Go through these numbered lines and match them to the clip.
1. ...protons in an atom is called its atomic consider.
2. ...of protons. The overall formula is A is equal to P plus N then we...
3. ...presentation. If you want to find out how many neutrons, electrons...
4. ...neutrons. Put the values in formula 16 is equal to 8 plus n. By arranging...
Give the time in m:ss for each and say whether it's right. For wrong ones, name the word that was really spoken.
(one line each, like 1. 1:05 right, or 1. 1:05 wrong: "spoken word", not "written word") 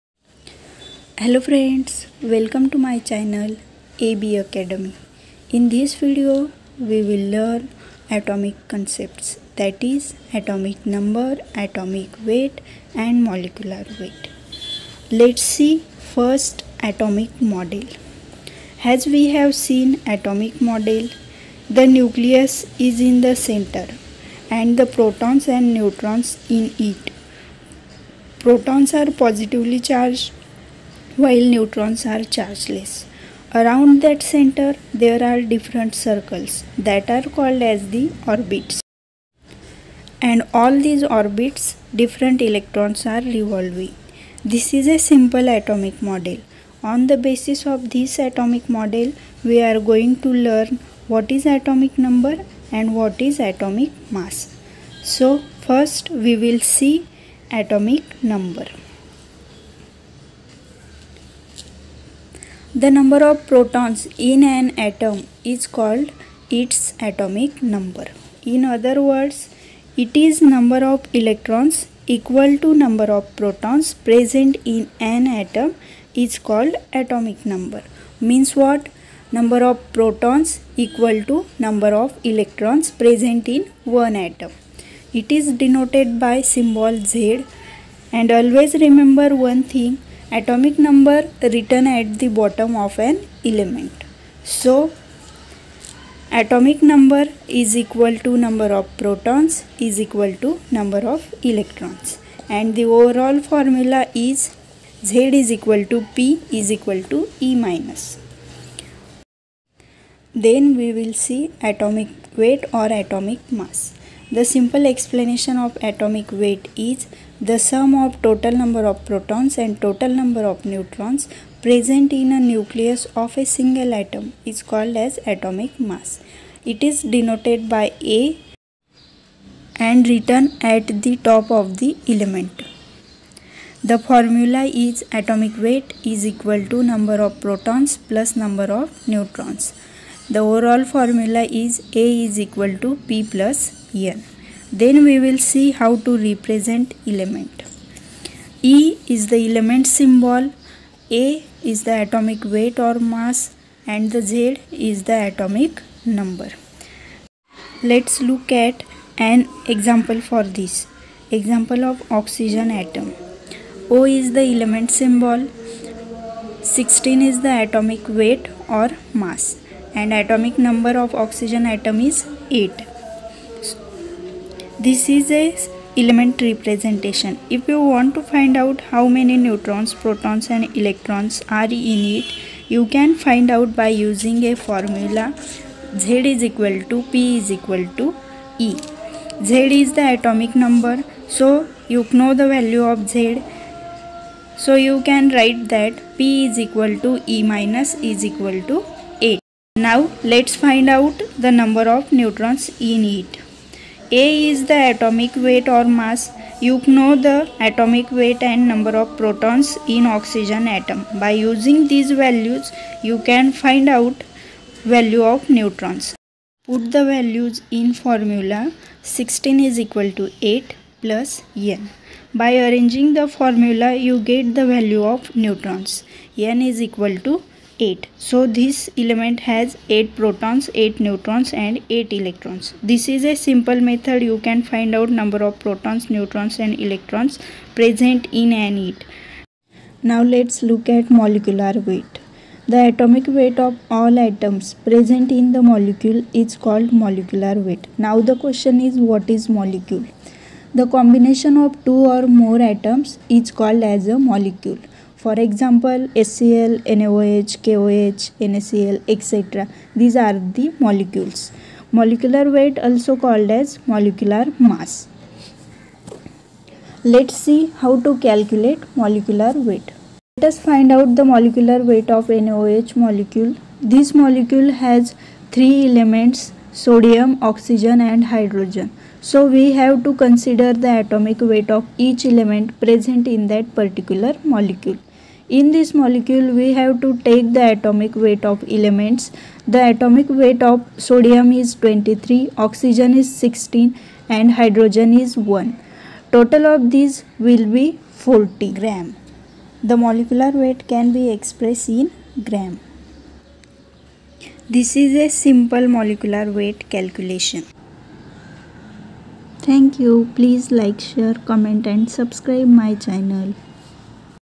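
1. 1:03 wrong: "number", not "consider"
2. 2:18 wrong: "neutrons", not "protons"
3. 2:56 wrong: "protons", not "electrons"
4. 3:35 right.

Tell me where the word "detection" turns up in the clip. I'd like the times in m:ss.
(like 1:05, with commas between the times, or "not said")
not said.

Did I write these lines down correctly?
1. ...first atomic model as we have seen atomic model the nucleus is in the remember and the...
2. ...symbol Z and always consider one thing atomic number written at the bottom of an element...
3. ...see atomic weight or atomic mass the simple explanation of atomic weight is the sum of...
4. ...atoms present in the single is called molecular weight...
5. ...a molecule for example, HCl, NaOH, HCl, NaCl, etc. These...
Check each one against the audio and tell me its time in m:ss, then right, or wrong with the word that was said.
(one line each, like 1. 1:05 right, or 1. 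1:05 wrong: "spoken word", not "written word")
1. 0:16 wrong: "center", not "remember"
2. 1:26 wrong: "remember", not "consider"
3. 1:51 right
4. 4:04 wrong: "molecule", not "single"
5. 4:14 wrong: "KOH", not "HCl".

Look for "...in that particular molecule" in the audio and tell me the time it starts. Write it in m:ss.
4:43.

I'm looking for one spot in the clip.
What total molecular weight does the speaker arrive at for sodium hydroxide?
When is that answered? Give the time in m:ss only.
4:58.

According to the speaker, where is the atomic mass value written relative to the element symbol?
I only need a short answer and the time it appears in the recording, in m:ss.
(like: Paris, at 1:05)
At the top, at 2:10.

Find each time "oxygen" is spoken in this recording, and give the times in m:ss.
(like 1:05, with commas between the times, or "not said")
2:42, 2:51, 3:30, 4:37, 4:52.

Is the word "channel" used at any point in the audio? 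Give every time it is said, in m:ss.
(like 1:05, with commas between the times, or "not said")
0:03, 5:12.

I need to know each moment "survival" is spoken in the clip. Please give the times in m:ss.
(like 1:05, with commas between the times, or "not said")
not said.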